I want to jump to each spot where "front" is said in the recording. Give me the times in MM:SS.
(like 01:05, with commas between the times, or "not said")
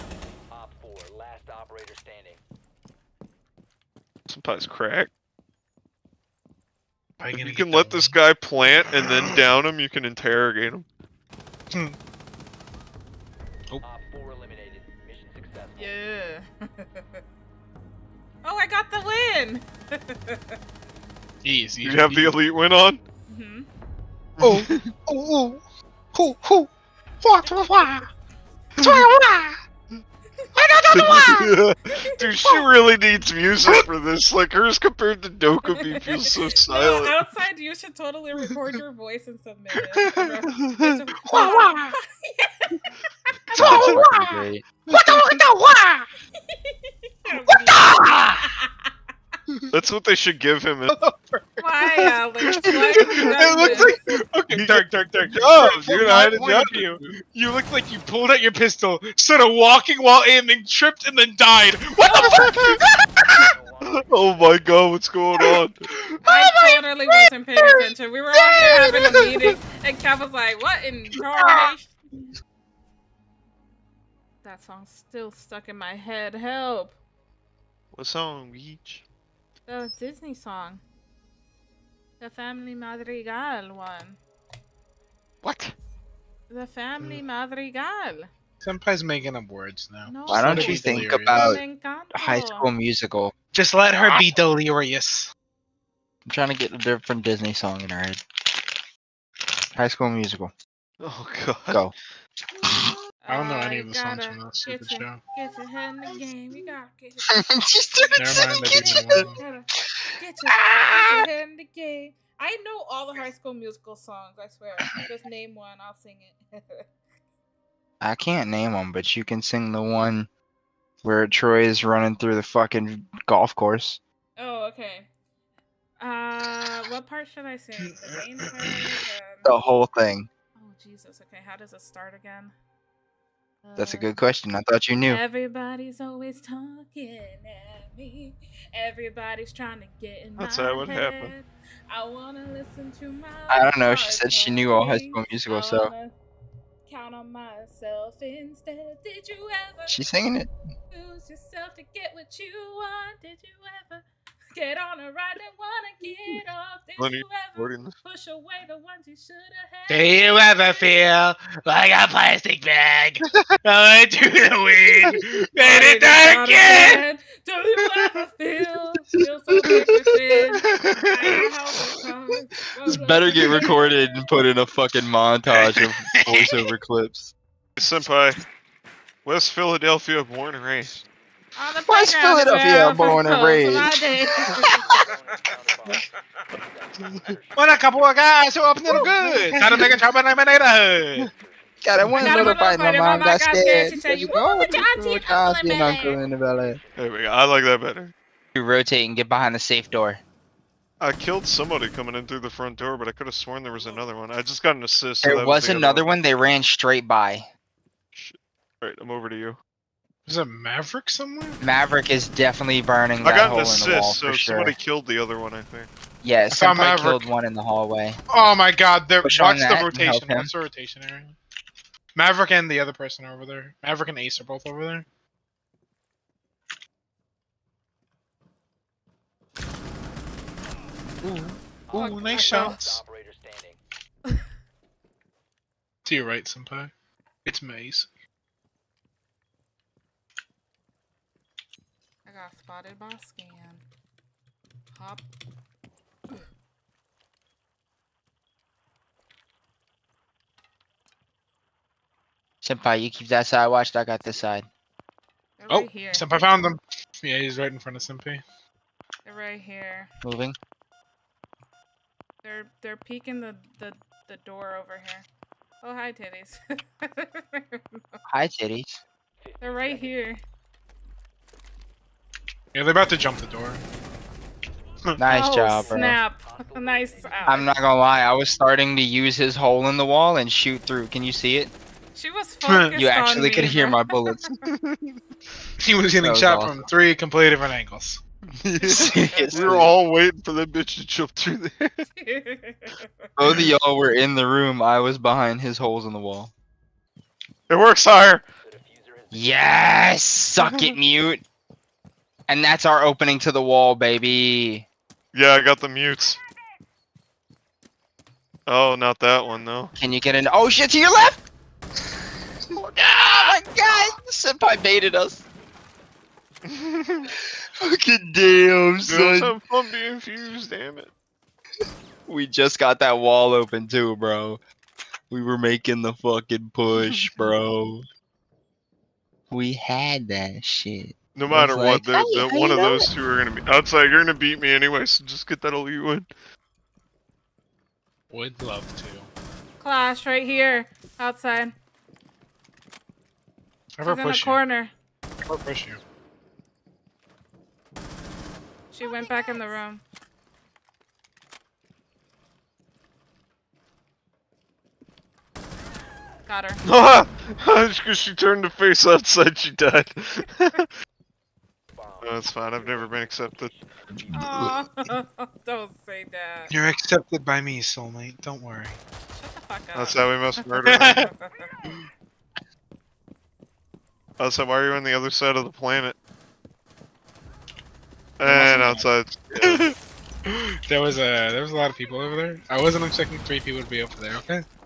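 03:22, 04:17.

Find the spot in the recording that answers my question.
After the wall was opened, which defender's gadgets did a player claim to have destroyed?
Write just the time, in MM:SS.
05:00.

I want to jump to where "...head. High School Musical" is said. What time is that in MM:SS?
01:37.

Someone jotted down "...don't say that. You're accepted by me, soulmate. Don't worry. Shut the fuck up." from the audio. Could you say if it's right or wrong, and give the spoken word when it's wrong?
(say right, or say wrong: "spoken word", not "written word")
right.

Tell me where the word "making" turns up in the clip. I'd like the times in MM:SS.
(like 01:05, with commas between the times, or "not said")
01:29, 05:25.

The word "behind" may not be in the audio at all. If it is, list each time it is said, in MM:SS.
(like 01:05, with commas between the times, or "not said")
03:19, 04:55.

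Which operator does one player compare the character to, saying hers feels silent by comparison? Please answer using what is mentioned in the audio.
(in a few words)
Dokkaebi.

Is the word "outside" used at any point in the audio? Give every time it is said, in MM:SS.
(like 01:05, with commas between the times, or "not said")
00:37, 05:33, 05:41, 05:59, 06:18.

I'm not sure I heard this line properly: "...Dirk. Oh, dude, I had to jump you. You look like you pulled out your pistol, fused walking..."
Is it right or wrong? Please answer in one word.
wrong.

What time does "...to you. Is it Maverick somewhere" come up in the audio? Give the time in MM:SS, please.
03:29.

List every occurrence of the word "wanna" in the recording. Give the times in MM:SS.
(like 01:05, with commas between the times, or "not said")
02:22, 02:35.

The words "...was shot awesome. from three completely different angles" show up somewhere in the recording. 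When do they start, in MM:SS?
04:46.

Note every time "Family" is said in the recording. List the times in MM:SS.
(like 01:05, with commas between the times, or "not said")
01:22, 01:26.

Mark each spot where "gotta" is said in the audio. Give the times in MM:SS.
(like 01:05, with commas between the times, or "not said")
01:46.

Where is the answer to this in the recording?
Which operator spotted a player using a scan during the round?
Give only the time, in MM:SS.
03:57.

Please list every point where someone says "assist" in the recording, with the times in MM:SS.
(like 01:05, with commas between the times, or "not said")
03:24, 03:33.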